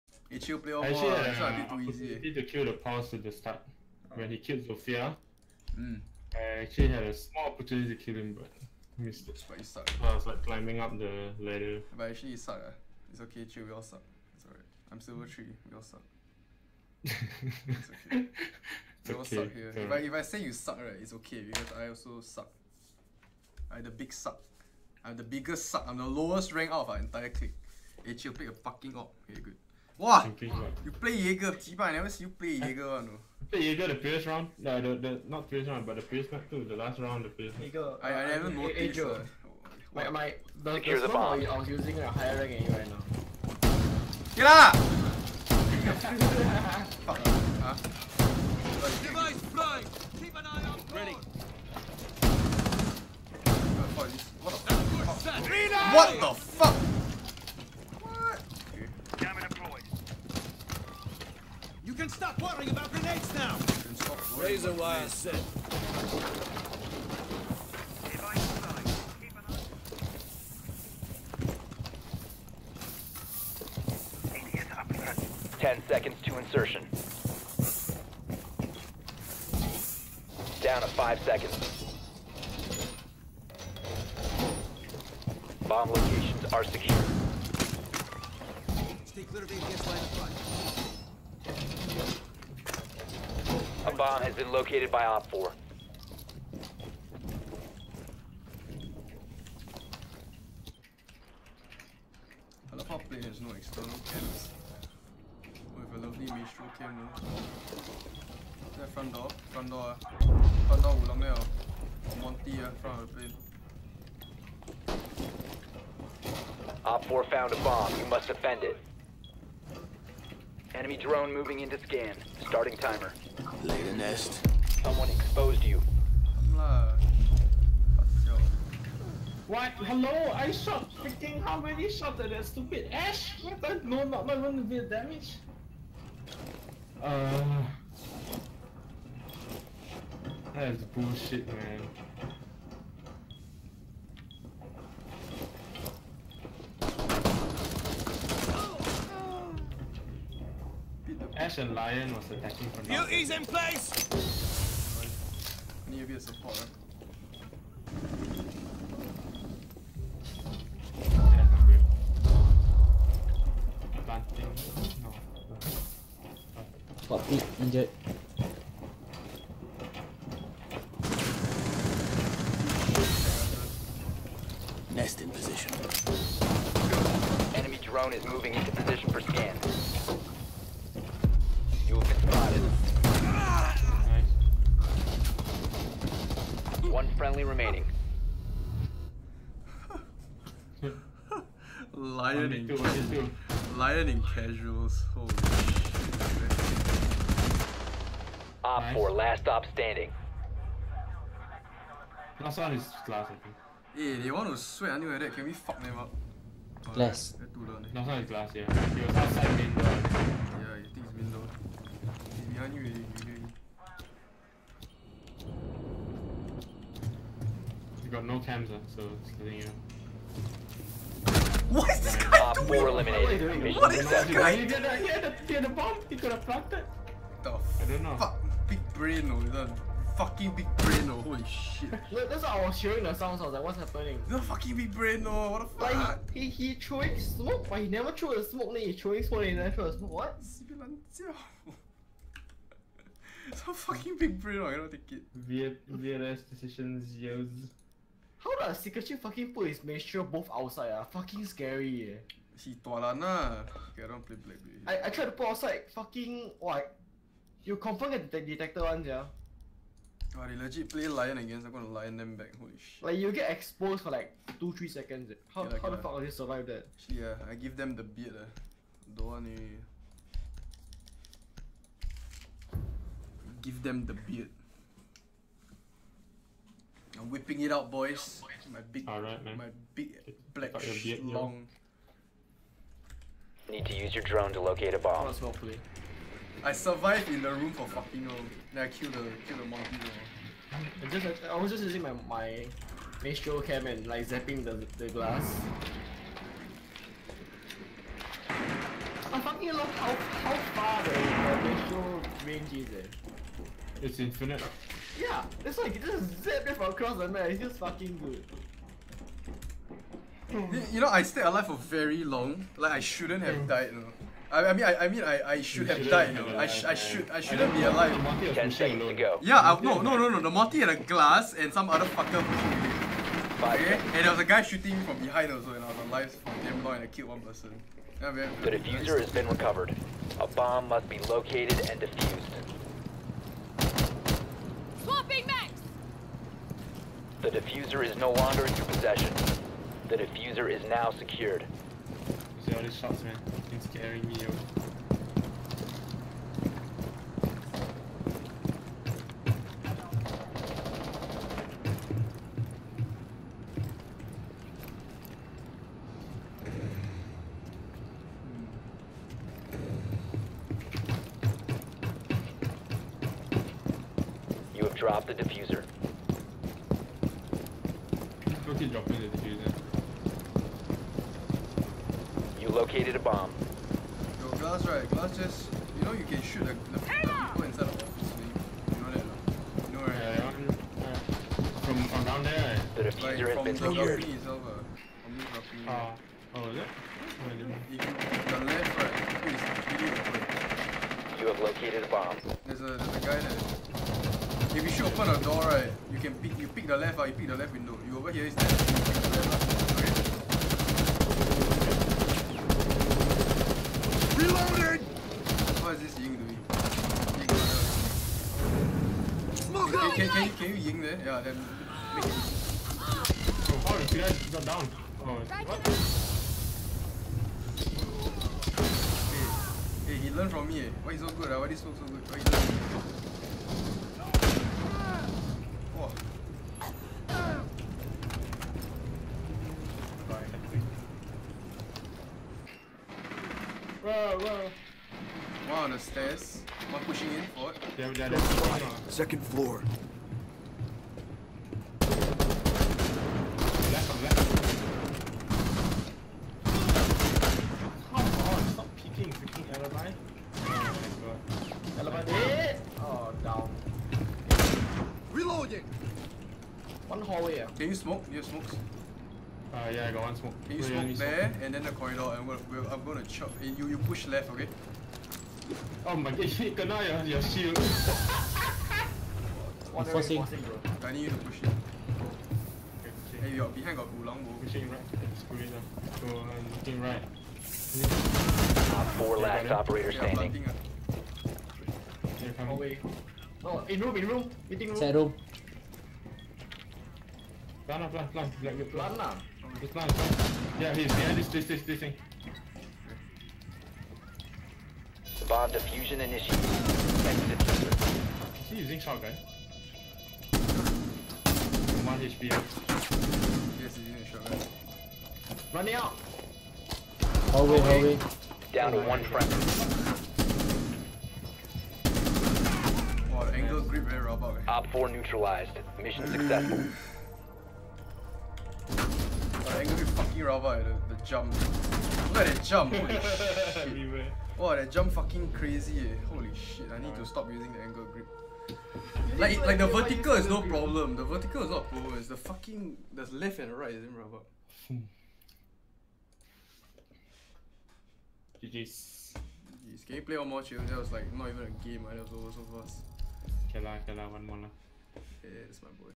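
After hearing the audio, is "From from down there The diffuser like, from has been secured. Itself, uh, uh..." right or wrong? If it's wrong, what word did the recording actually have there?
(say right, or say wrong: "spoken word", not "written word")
right.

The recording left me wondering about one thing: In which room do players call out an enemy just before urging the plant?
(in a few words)
Meeting room.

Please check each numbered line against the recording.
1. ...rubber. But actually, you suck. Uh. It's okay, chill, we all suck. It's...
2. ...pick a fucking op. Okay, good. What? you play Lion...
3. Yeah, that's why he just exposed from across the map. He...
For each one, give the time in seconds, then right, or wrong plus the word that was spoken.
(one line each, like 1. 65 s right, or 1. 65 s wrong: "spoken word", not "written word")
1. 11 s wrong: "ladder", not "rubber"
2. 28 s wrong: "Jaeger", not "Lion"
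3. 305 s wrong: "zapped", not "exposed".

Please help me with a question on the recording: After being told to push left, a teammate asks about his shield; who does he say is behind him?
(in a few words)
Gulong.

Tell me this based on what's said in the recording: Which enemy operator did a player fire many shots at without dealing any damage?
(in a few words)
Ash.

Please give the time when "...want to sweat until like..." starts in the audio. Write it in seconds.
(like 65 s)
204 s.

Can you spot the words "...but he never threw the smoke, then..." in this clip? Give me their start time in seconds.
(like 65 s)
237 s.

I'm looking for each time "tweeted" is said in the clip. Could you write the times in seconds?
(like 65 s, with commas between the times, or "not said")
not said.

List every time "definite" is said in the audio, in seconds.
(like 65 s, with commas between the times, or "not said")
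not said.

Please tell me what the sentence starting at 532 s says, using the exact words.
It's the fucking the left and right isn't rubber.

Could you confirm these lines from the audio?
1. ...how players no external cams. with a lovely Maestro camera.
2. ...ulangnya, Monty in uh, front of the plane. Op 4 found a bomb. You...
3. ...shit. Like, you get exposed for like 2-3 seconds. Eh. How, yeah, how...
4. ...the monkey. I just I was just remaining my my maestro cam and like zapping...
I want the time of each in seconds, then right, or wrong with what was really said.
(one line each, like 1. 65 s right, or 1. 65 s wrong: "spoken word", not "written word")
1. 102 s right
2. 111 s right
3. 262 s right
4. 289 s wrong: "using", not "remaining".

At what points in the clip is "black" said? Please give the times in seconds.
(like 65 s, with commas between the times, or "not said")
254 s, 280 s.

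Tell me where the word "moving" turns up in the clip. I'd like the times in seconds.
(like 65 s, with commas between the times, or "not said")
121 s, 178 s.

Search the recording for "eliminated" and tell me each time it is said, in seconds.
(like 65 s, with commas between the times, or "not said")
222 s.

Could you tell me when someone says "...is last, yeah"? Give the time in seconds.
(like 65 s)
208 s.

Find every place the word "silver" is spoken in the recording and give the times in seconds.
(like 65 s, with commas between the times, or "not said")
15 s.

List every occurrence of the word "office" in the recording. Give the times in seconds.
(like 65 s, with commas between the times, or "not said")
377 s.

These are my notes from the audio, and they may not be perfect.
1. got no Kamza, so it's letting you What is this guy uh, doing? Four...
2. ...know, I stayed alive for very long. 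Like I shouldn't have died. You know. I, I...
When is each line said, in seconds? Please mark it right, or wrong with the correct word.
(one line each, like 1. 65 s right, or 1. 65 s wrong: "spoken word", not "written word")
1. 218 s right
2. 310 s right.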